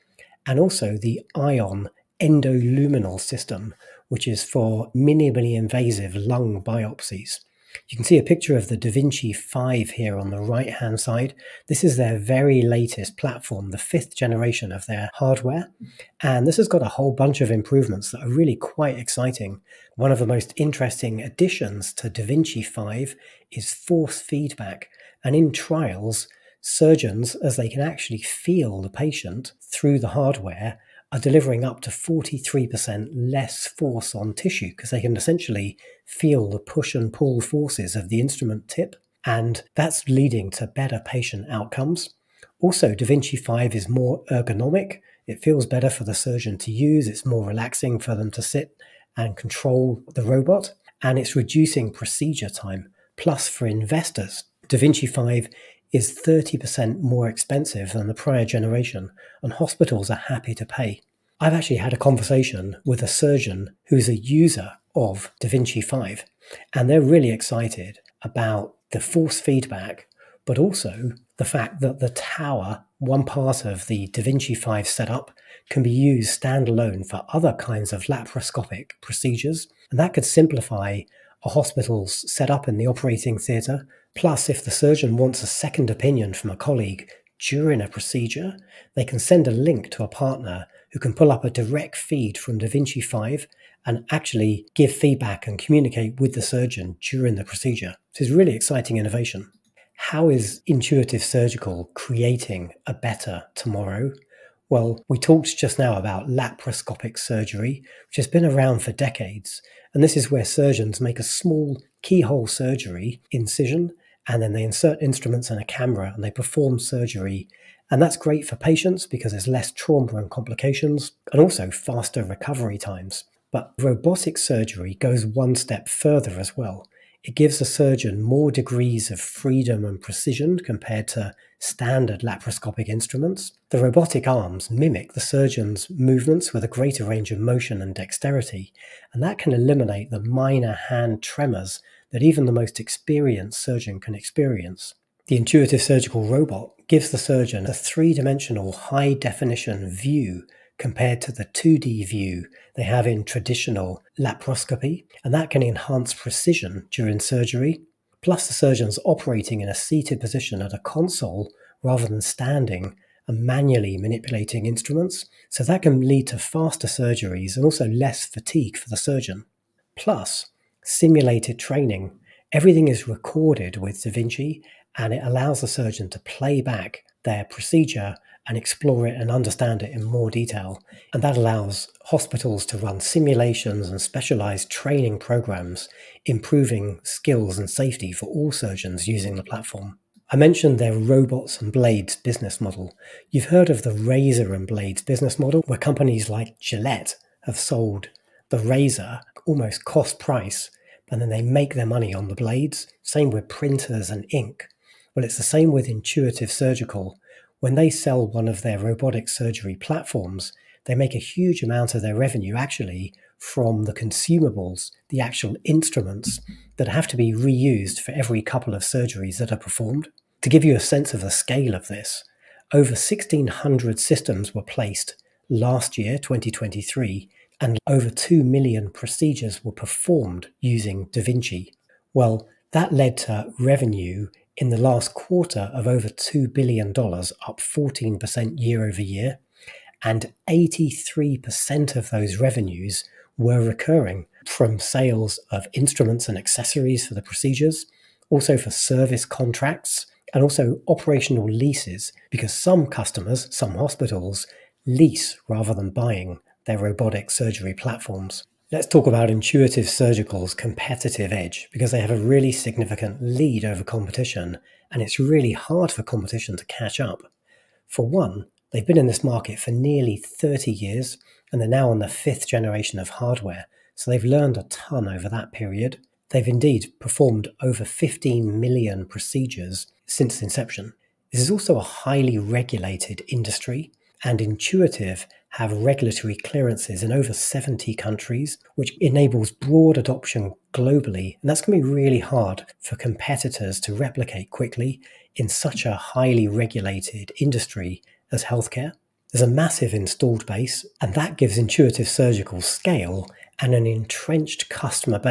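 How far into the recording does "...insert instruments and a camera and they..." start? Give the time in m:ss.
1:54.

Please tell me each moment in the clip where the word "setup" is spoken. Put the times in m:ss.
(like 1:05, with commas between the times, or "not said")
1:14, 1:22.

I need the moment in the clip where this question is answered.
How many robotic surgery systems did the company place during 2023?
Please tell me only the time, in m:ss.
3:42.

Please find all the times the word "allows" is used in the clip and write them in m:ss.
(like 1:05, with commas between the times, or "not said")
2:55, 3:01.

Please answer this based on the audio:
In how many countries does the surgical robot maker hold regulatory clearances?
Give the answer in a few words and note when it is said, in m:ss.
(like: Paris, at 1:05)
over 70, at 4:47.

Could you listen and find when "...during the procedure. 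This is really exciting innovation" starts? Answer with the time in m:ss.
1:37.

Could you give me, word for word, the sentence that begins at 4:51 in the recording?
And that's going to be really hard for competitors to replicate quickly in such a highly regulated industry as healthcare.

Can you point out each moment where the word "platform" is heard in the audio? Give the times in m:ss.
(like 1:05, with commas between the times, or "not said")
0:13, 3:09, 3:29, 4:17.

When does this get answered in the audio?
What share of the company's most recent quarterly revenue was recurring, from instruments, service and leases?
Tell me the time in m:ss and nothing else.
4:00.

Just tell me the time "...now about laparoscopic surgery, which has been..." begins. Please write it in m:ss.
1:45.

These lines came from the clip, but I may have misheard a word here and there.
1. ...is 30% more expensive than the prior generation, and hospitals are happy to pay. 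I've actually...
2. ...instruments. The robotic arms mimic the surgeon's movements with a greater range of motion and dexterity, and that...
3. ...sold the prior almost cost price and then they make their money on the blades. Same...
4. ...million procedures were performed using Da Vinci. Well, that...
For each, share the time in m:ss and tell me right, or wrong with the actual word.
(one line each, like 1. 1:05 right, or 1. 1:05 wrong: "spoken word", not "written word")
1. 0:55 right
2. 2:12 right
3. 3:17 wrong: "razor", not "prior"
4. 3:48 right.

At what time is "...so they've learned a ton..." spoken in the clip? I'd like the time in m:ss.
4:33.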